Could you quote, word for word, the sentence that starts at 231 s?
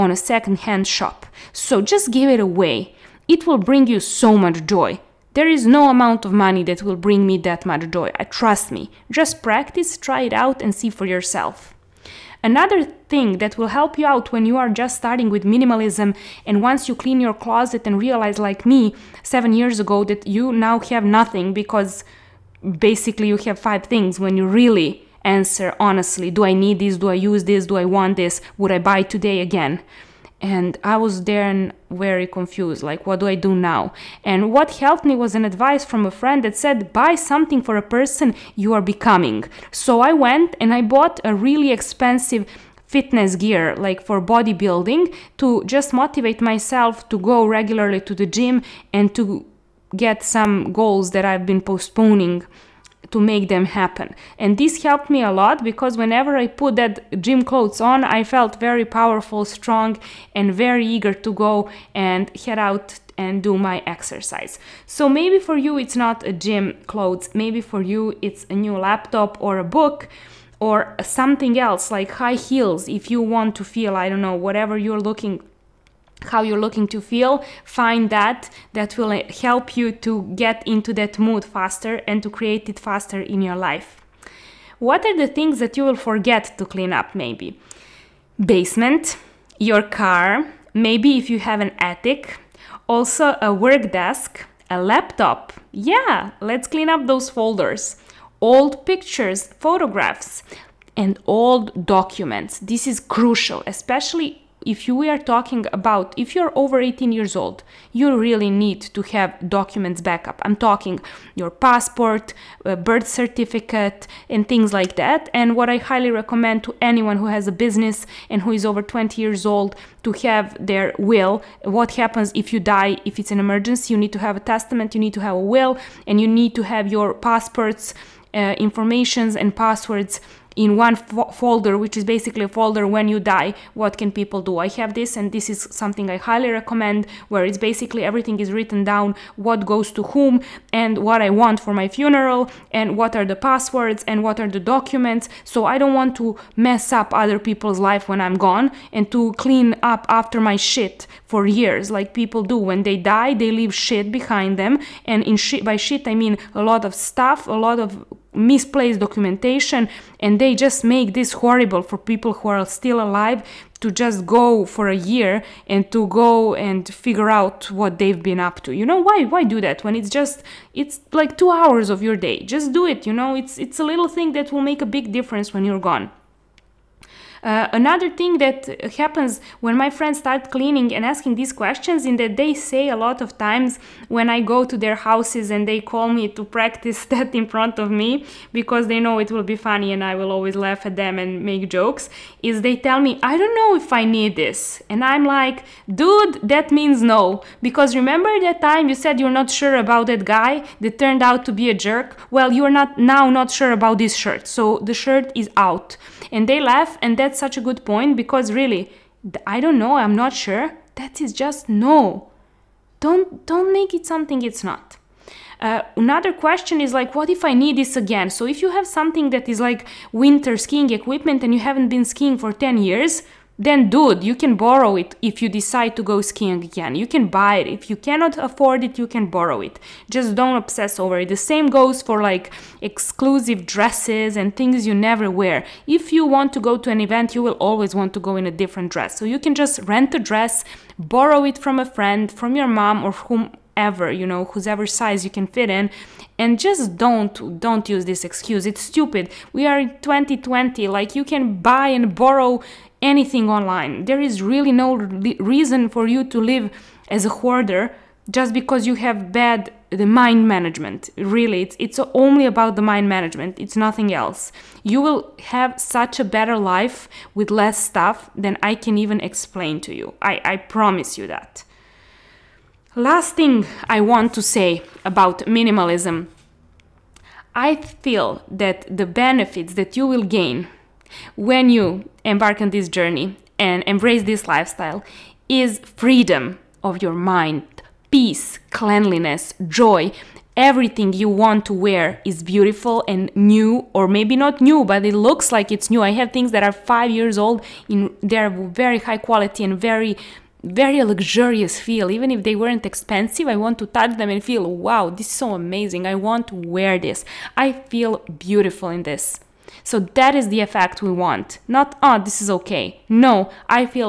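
The same goes for like exclusive dresses and things you never wear.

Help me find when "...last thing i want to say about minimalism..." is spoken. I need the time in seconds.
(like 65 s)
272 s.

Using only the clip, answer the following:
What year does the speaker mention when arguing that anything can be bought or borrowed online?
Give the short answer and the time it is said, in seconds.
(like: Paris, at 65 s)
2020, at 250 s.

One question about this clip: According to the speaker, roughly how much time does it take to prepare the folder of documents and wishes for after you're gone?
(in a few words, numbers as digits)
2 hours.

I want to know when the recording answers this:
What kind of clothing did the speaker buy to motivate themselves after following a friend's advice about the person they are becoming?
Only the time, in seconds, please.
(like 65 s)
42 s.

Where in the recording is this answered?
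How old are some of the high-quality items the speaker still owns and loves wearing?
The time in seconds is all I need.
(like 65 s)
296 s.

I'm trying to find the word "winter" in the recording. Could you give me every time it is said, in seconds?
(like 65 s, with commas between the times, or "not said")
220 s.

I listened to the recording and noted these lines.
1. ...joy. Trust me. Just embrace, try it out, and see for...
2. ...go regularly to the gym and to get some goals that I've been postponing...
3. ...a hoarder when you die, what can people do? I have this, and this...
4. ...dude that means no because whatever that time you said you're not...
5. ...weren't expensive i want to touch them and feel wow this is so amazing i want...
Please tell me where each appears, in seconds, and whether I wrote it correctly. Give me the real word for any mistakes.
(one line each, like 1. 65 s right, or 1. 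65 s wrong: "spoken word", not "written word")
1. 7 s wrong: "practice", not "embrace"
2. 47 s right
3. 132 s wrong: "folder", not "hoarder"
4. 195 s wrong: "remember", not "whatever"
5. 302 s right.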